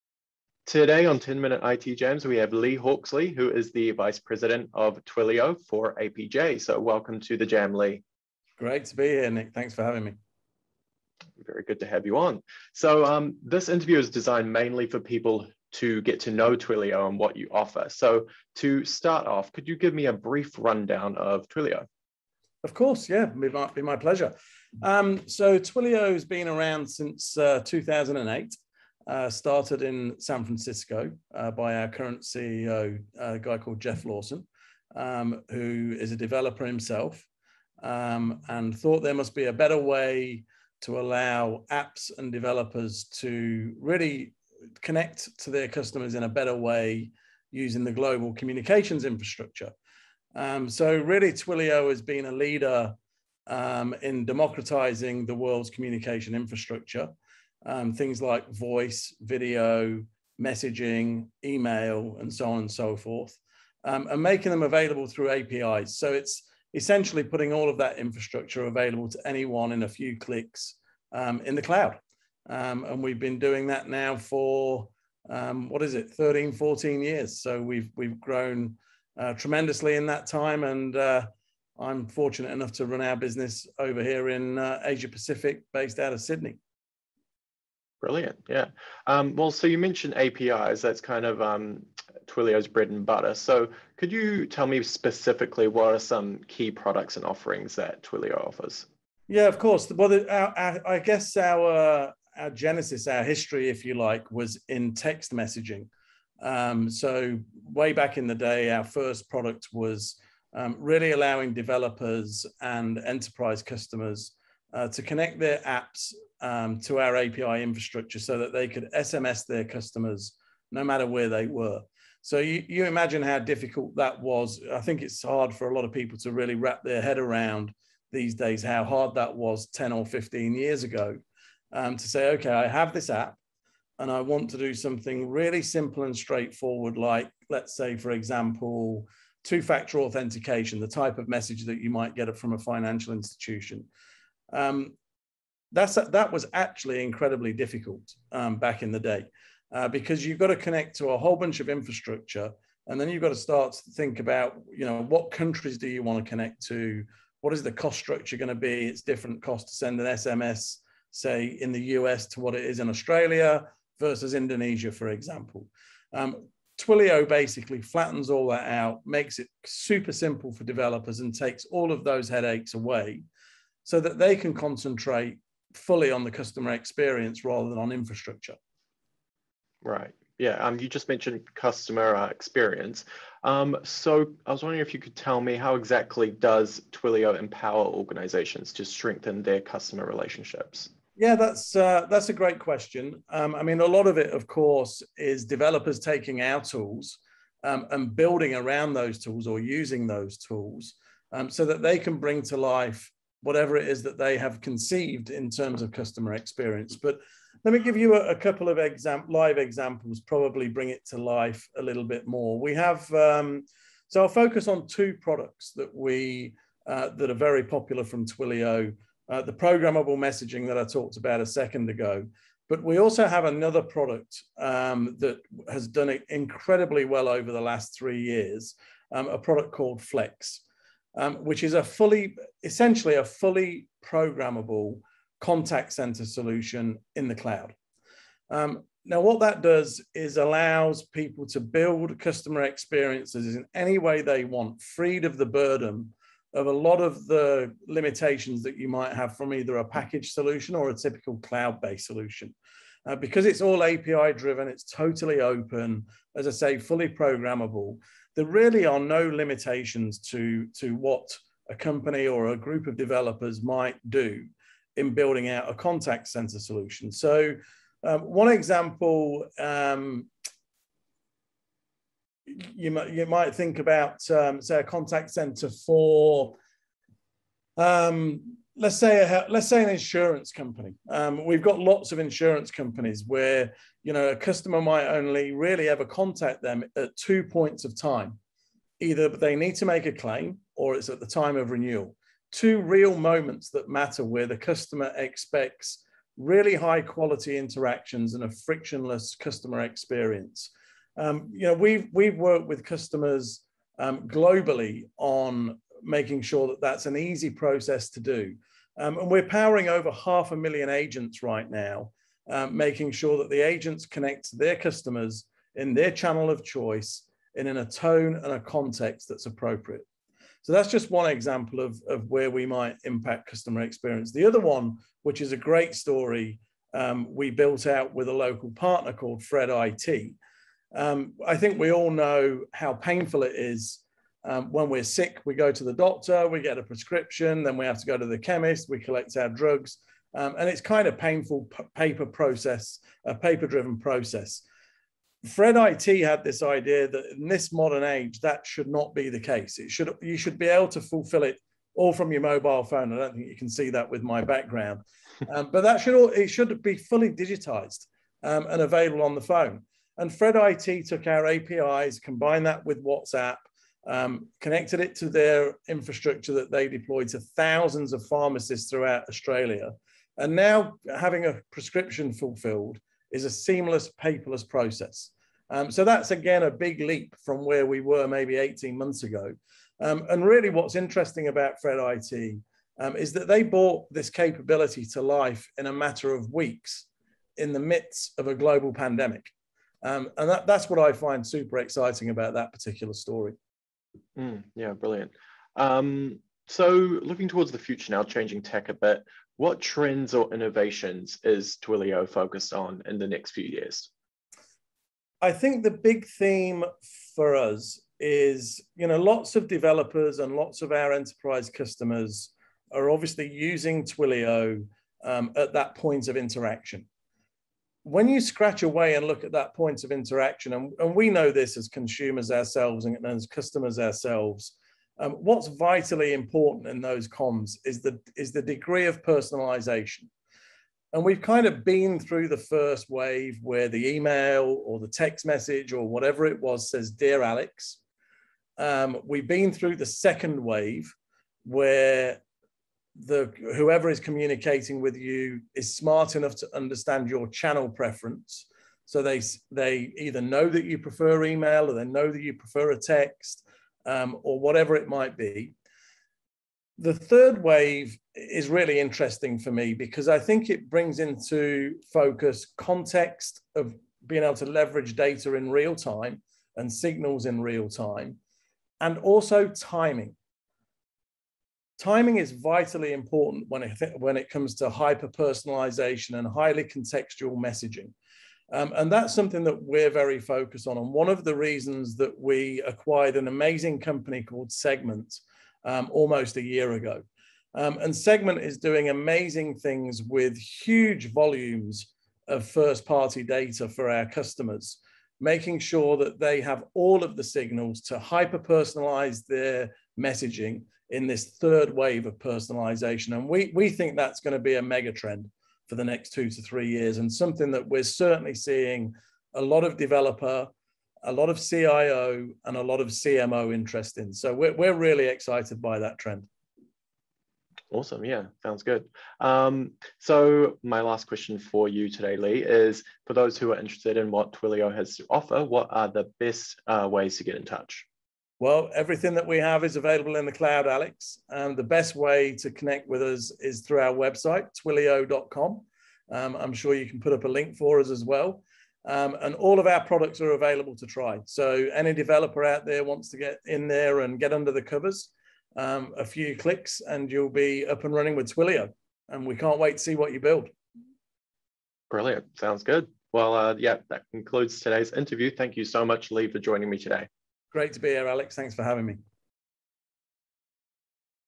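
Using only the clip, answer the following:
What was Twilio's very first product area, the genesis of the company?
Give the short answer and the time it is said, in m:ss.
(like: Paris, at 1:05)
Text messaging, at 1:44.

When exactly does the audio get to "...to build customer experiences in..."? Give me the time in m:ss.
4:01.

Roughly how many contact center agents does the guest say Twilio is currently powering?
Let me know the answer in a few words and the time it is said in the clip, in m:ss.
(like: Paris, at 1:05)
Half a million, at 5:10.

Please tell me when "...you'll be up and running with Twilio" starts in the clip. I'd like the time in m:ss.
9:07.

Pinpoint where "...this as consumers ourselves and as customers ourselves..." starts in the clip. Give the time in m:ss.
7:01.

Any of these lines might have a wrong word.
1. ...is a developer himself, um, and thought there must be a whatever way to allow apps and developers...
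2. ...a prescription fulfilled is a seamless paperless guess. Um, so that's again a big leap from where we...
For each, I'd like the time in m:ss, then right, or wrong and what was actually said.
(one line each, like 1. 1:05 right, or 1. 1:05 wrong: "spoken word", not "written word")
1. 0:35 wrong: "better", not "whatever"
2. 6:11 wrong: "process", not "guess".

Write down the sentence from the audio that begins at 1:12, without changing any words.
Um, and we've been doing that now for, um, what is it, 13, 14 years.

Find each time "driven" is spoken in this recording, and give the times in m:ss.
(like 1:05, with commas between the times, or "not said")
4:14, 5:43.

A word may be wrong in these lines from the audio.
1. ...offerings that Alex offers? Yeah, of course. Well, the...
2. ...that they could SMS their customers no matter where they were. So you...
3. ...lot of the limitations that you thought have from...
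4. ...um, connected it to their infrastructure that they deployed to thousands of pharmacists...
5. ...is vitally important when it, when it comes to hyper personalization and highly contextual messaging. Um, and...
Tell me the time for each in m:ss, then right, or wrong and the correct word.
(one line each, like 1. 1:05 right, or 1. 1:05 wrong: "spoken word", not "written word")
1. 1:37 wrong: "Twilio", not "Alex"
2. 1:58 right
3. 4:06 wrong: "might", not "thought"
4. 6:04 right
5. 7:52 right.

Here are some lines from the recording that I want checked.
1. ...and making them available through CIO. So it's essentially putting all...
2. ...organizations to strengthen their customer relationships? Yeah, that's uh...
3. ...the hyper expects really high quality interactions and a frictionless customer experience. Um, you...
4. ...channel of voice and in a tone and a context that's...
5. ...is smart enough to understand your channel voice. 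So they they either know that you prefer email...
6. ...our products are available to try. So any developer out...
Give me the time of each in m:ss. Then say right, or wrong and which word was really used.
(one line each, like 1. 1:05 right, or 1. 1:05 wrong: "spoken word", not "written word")
1. 1:04 wrong: "APIs", not "CIO"
2. 3:07 right
3. 4:54 wrong: "customer", not "hyper"
4. 5:16 wrong: "choice", not "voice"
5. 7:25 wrong: "preference", not "voice"
6. 8:59 right.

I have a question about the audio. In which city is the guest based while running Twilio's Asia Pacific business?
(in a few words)
Sydney.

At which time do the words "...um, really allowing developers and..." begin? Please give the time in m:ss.
1:50.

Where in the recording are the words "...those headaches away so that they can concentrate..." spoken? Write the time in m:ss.
2:52.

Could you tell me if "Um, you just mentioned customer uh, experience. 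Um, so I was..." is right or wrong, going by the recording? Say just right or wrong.
right.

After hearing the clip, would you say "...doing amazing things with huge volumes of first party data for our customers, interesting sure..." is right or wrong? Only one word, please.
wrong.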